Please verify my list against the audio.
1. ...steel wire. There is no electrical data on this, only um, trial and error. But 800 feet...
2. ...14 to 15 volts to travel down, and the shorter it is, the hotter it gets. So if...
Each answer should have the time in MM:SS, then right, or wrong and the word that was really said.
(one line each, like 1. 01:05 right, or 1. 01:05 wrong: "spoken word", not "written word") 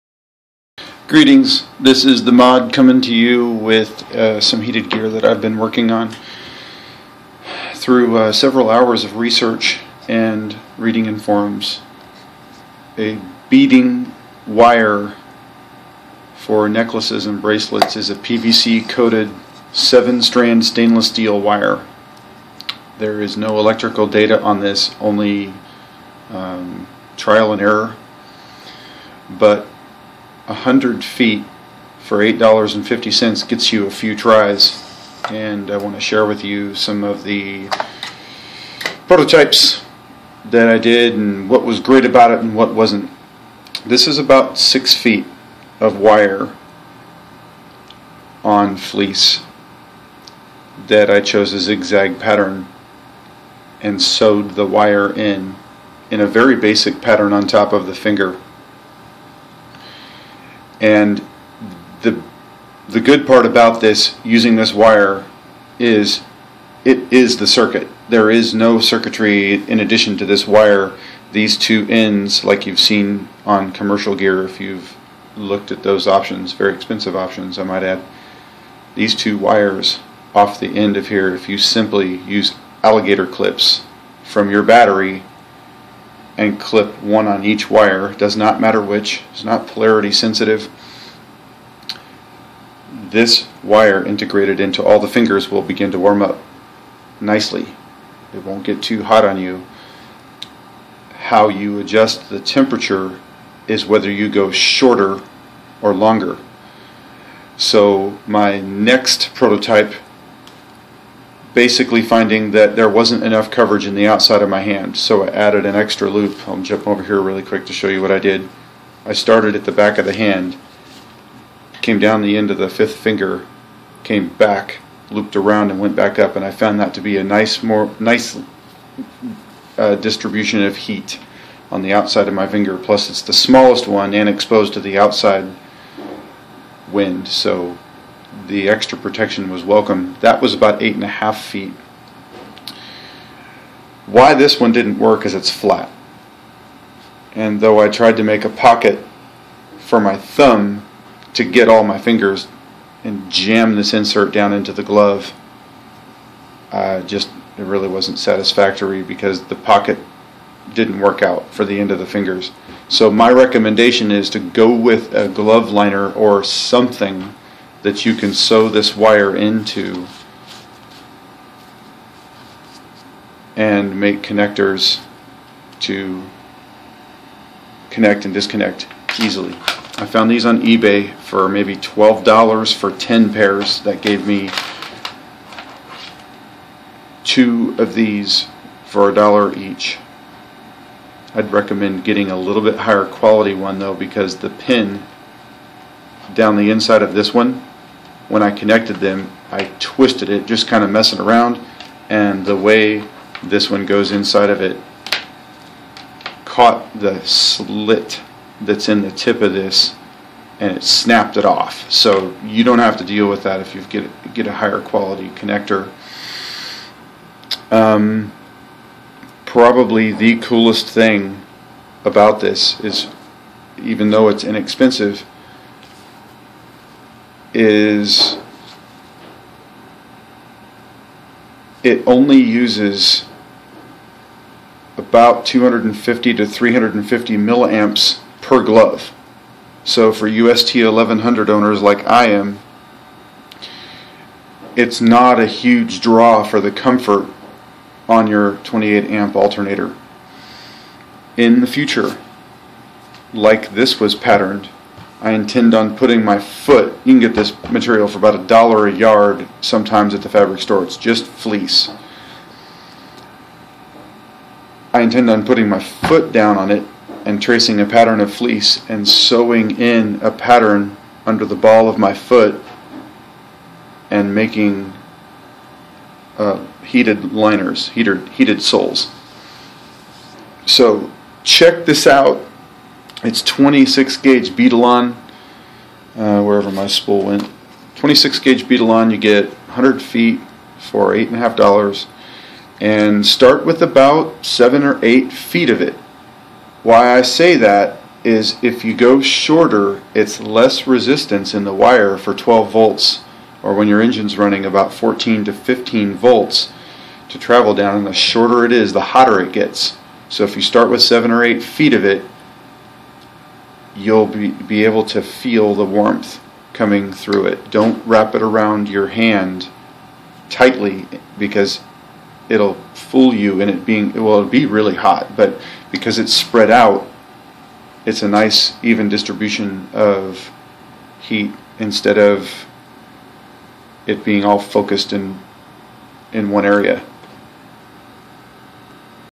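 1. 00:21 wrong: "100", not "800"
2. 05:04 right.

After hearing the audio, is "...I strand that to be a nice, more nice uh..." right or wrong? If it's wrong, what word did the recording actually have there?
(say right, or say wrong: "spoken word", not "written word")
wrong: "found", not "strand".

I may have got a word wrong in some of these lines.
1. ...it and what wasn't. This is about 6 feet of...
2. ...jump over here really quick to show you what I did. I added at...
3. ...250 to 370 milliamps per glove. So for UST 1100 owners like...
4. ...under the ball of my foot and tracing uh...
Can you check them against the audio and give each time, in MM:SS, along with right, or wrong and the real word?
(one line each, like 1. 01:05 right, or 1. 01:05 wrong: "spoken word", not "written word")
1. 00:42 right
2. 01:56 wrong: "started", not "added"
3. 03:55 wrong: "350", not "370"
4. 04:31 wrong: "making", not "tracing".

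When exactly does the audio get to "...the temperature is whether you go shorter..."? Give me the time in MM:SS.
01:42.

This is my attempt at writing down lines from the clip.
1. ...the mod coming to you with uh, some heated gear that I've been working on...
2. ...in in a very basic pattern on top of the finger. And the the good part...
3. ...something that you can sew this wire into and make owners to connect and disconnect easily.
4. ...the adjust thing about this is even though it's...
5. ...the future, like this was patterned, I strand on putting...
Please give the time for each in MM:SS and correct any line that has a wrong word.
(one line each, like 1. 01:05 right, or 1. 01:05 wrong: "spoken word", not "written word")
1. 00:02 right
2. 00:55 right
3. 02:46 wrong: "connectors", not "owners"
4. 03:40 wrong: "coolest", not "adjust"
5. 04:11 wrong: "intend", not "strand".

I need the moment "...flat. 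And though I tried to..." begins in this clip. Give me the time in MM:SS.
02:25.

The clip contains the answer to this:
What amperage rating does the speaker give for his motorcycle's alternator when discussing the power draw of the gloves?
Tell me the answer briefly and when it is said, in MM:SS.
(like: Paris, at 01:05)
28 amps, at 04:08.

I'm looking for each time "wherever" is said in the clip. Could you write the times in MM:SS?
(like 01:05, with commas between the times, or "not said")
04:46.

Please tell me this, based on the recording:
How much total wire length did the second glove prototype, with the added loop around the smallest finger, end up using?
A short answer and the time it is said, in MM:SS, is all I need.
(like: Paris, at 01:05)
8.5 feet, at 02:20.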